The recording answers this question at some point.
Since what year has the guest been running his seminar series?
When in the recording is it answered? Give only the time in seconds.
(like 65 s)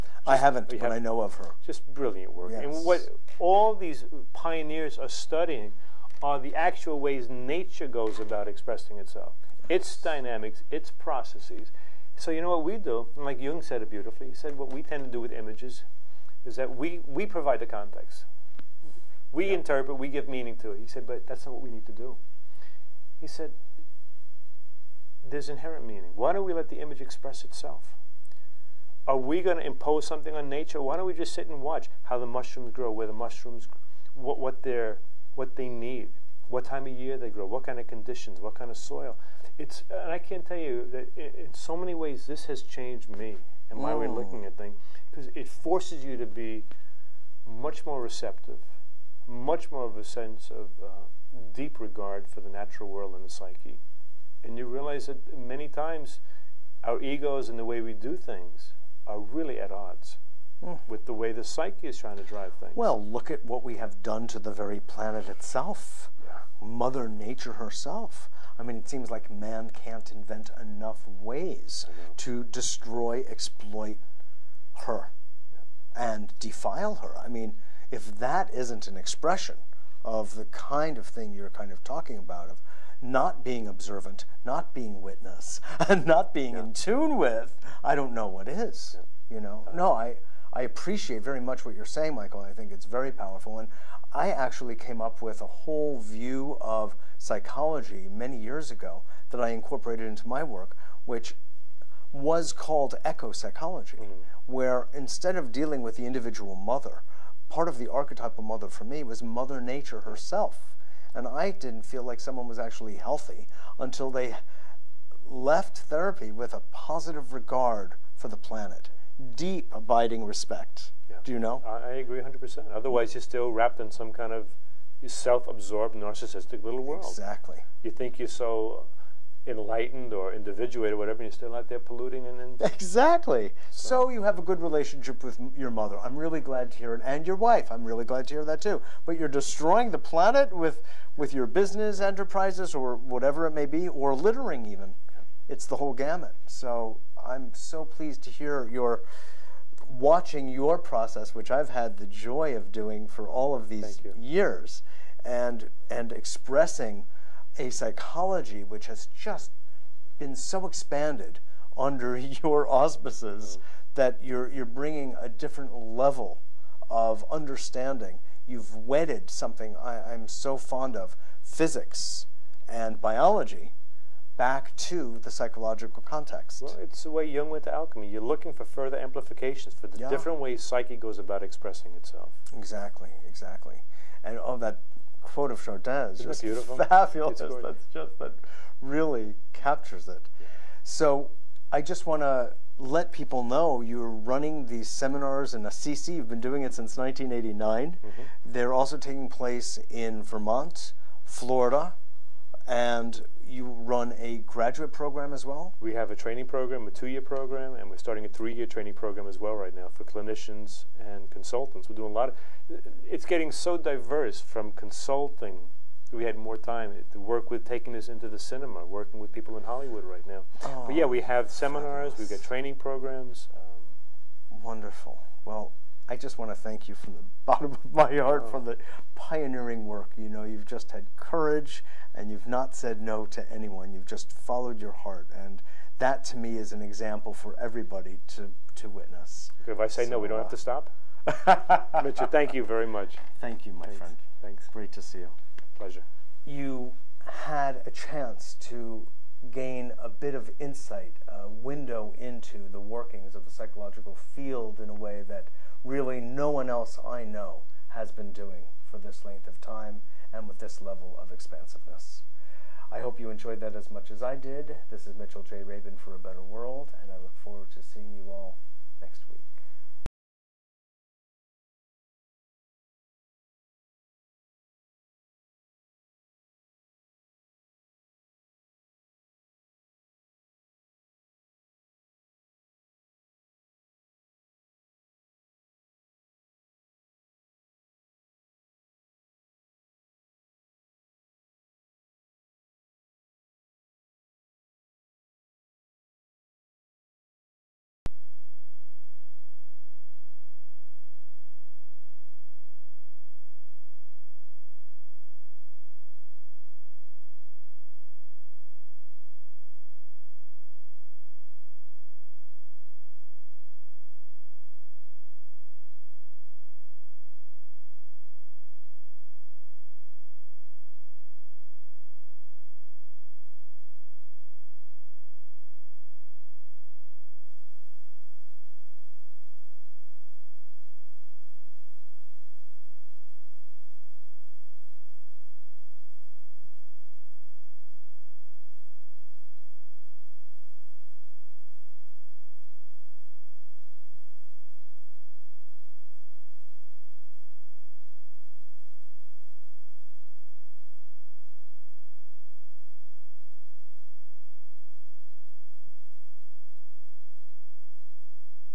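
196 s.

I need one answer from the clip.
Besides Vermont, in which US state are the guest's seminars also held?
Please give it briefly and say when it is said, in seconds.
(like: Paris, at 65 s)
Florida, at 201 s.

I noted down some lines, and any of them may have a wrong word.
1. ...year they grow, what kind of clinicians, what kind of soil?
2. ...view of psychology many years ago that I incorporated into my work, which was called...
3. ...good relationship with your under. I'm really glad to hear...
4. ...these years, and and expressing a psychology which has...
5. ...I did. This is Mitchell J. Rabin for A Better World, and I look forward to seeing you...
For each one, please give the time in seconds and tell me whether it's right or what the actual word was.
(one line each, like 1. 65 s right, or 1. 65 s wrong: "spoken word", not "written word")
1. 36 s wrong: "conditions", not "clinicians"
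2. 95 s right
3. 134 s wrong: "mother", not "under"
4. 153 s right
5. 264 s right.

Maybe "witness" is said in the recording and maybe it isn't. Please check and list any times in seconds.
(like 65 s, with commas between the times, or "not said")
85 s, 238 s.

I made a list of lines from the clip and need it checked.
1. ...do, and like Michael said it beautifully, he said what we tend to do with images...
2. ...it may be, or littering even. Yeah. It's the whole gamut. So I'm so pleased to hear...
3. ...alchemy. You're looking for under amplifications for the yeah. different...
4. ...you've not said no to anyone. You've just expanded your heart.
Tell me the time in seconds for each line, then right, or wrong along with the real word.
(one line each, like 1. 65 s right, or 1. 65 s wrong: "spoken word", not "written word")
1. 12 s wrong: "Jung", not "Michael"
2. 143 s right
3. 177 s wrong: "further", not "under"
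4. 232 s wrong: "followed", not "expanded".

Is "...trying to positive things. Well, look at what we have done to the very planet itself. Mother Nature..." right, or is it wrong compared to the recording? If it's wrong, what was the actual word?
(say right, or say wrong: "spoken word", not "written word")
wrong: "drive", not "positive".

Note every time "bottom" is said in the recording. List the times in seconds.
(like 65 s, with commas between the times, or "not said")
227 s.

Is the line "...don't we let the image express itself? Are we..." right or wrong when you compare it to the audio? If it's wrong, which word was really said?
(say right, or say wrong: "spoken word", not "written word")
right.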